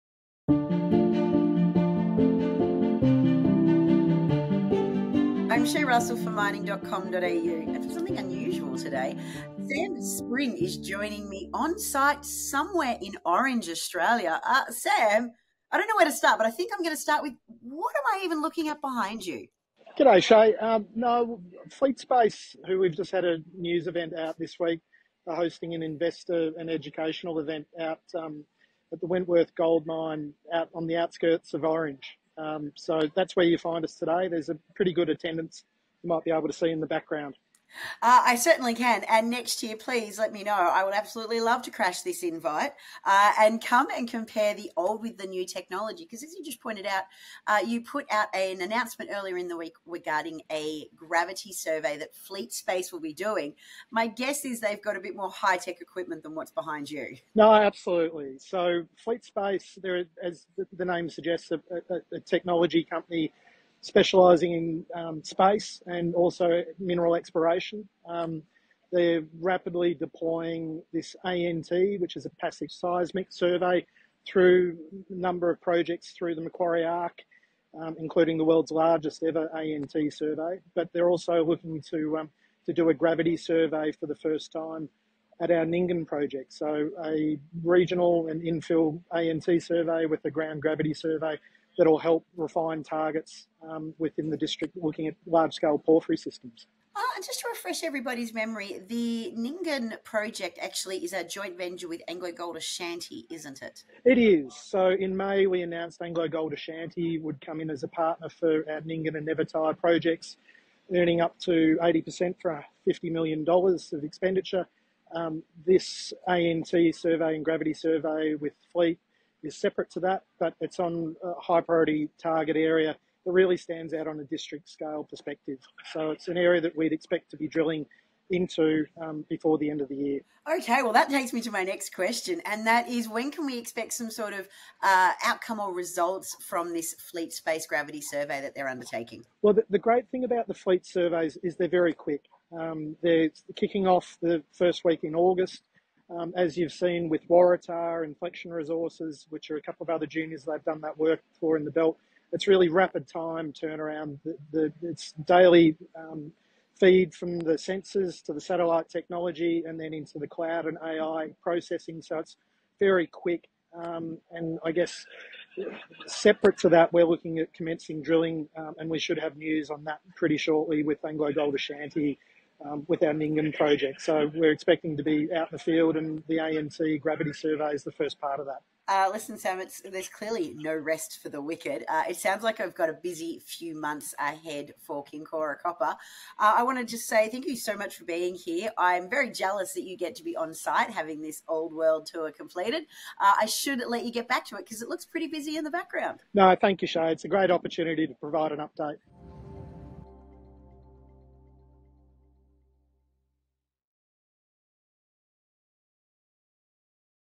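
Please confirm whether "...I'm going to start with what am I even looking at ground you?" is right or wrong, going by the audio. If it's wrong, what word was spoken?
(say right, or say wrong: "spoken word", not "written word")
wrong: "behind", not "ground".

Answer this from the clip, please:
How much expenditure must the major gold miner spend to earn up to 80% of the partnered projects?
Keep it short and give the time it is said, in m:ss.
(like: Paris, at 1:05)
$50 million, at 1:52.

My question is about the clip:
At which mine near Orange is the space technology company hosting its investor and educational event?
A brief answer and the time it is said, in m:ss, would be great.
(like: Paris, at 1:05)
Wentworth Gold Mine, at 0:29.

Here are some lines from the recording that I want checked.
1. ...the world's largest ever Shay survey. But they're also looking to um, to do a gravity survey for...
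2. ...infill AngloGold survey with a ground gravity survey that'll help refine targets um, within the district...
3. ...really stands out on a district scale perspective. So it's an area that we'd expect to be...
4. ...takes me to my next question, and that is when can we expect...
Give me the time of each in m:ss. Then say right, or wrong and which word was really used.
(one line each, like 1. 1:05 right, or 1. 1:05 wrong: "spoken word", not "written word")
1. 1:18 wrong: "ANT", not "Shay"
2. 1:28 wrong: "ANT", not "AngloGold"
3. 2:03 right
4. 2:11 right.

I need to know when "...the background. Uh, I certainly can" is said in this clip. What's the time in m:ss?
0:36.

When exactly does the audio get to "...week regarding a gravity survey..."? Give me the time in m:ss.
0:49.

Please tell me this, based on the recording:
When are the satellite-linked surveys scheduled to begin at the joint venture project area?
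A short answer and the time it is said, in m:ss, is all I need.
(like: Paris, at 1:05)
First week in August, at 2:24.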